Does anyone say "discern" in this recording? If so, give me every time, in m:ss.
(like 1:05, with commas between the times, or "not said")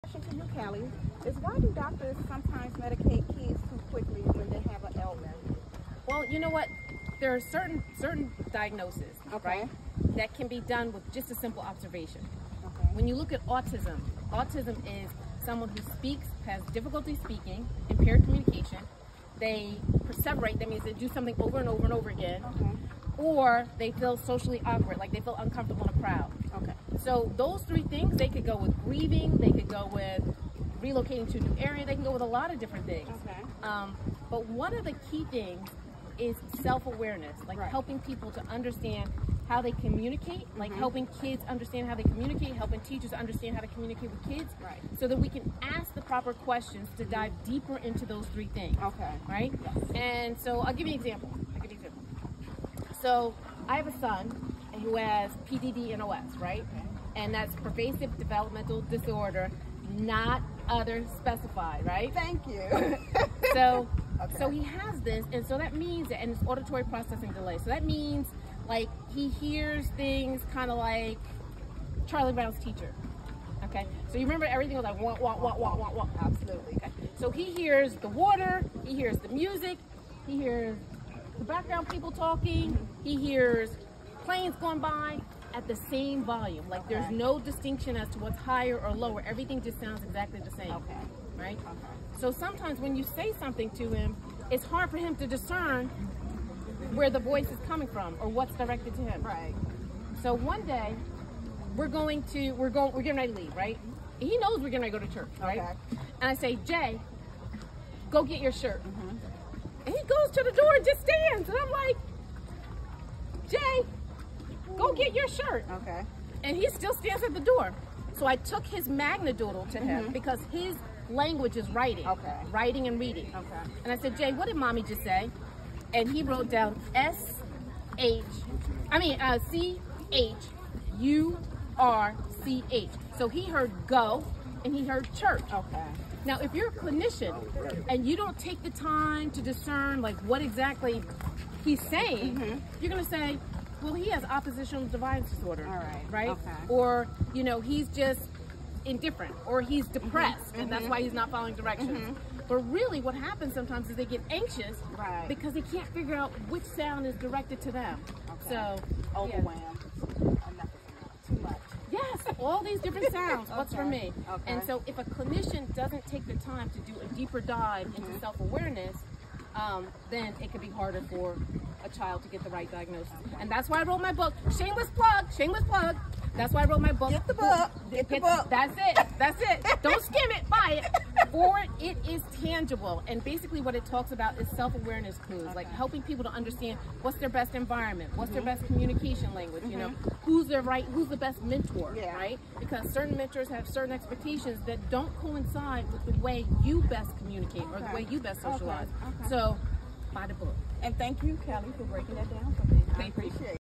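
1:35, 2:19.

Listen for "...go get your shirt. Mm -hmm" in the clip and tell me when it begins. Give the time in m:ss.
1:48.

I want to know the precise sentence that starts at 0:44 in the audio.
so that we can ask the proper questions to dive deeper into those three things.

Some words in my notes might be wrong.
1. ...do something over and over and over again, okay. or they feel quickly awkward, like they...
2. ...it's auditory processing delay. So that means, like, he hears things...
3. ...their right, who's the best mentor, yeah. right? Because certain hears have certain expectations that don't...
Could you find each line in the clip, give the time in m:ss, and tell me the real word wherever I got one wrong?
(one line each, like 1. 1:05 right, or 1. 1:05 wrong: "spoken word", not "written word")
1. 0:20 wrong: "socially", not "quickly"
2. 1:06 right
3. 3:10 wrong: "mentors", not "hears".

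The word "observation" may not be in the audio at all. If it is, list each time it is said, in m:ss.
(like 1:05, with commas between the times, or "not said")
0:11.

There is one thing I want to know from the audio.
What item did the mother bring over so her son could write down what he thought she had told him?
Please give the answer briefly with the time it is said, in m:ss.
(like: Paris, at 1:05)
Magna Doodle, at 1:58.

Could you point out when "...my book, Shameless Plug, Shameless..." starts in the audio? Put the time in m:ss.
2:54.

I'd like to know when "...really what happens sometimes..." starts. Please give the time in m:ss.
2:32.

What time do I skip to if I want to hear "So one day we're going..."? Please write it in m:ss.
1:40.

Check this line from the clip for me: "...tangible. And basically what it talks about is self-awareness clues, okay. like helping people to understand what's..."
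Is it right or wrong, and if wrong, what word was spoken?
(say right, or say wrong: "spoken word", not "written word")
right.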